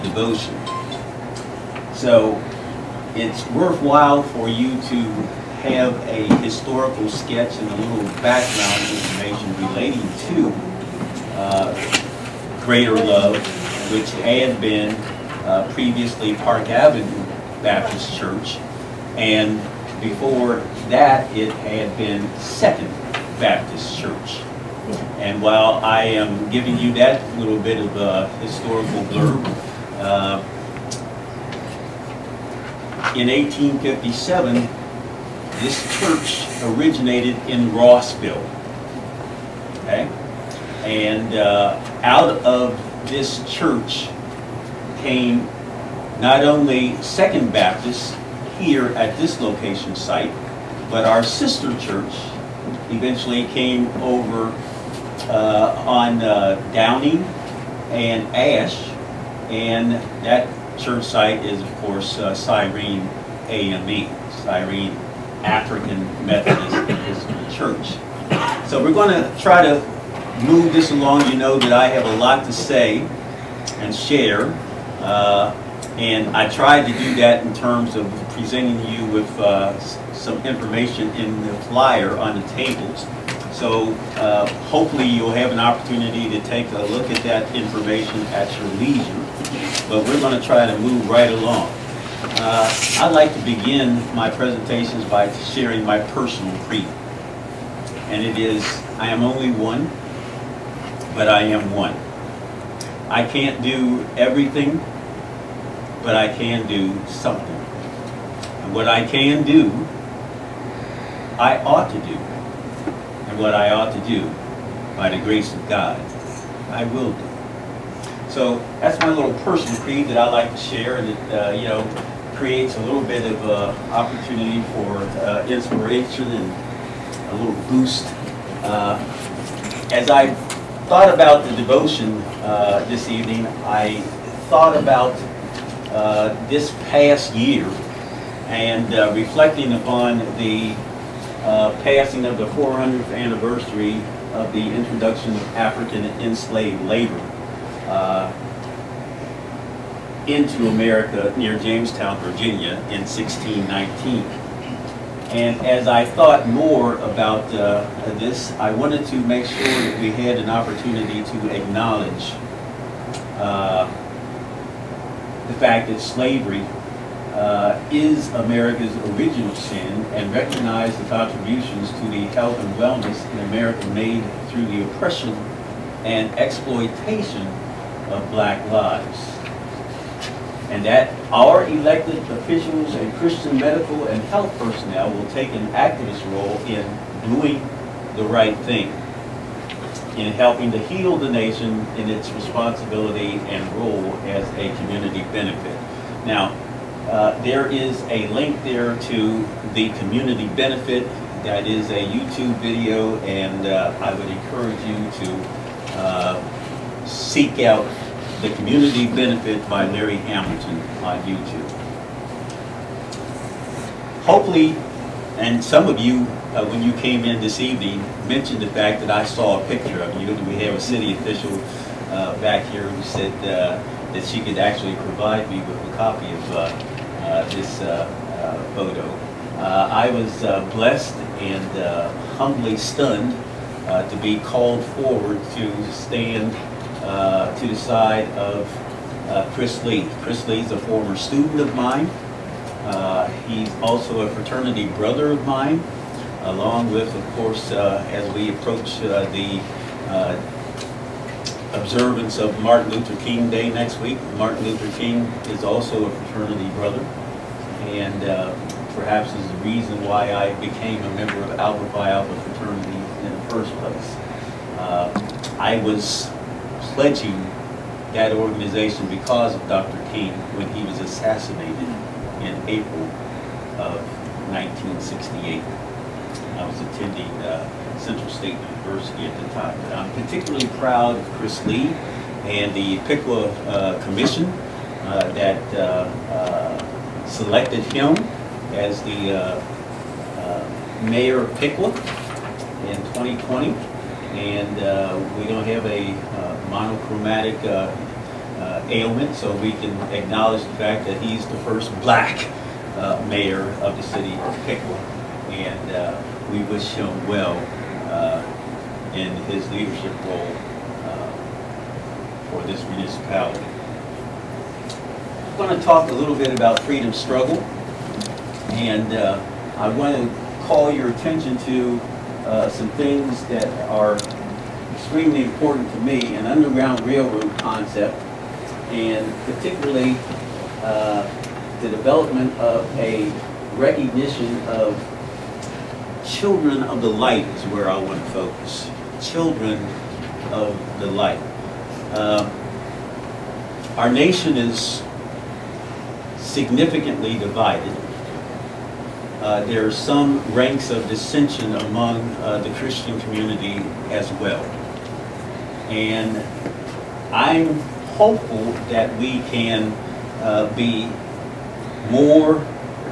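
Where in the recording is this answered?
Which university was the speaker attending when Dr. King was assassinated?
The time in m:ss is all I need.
4:37.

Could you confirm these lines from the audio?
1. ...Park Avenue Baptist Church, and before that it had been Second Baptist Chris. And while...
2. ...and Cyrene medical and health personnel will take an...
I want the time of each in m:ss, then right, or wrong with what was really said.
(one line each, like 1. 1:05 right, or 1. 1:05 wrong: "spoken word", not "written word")
1. 0:16 wrong: "Church", not "Chris"
2. 3:02 wrong: "Christian", not "Cyrene".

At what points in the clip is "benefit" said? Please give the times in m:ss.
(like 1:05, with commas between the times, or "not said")
3:15, 3:20, 3:29.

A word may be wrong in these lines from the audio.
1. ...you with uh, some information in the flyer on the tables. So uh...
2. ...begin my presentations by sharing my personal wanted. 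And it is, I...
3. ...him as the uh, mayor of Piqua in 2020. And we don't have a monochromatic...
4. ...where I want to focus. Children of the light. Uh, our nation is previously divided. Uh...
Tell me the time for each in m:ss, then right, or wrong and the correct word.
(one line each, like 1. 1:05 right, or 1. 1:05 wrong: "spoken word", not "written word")
1. 1:18 right
2. 1:33 wrong: "creed", not "wanted"
3. 4:47 right
4. 5:37 wrong: "significantly", not "previously".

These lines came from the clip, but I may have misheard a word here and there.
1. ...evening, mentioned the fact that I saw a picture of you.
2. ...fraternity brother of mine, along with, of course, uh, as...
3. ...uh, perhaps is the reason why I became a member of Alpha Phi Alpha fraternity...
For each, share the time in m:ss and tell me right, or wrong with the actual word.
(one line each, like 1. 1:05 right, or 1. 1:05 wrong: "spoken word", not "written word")
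1. 3:37 right
2. 4:04 right
3. 4:18 right.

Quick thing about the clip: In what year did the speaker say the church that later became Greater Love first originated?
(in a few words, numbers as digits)
1857.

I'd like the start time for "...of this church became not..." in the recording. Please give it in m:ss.
0:42.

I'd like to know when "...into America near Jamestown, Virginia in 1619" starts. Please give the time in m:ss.
2:30.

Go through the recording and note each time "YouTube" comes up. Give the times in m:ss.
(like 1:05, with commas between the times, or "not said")
3:22, 3:31.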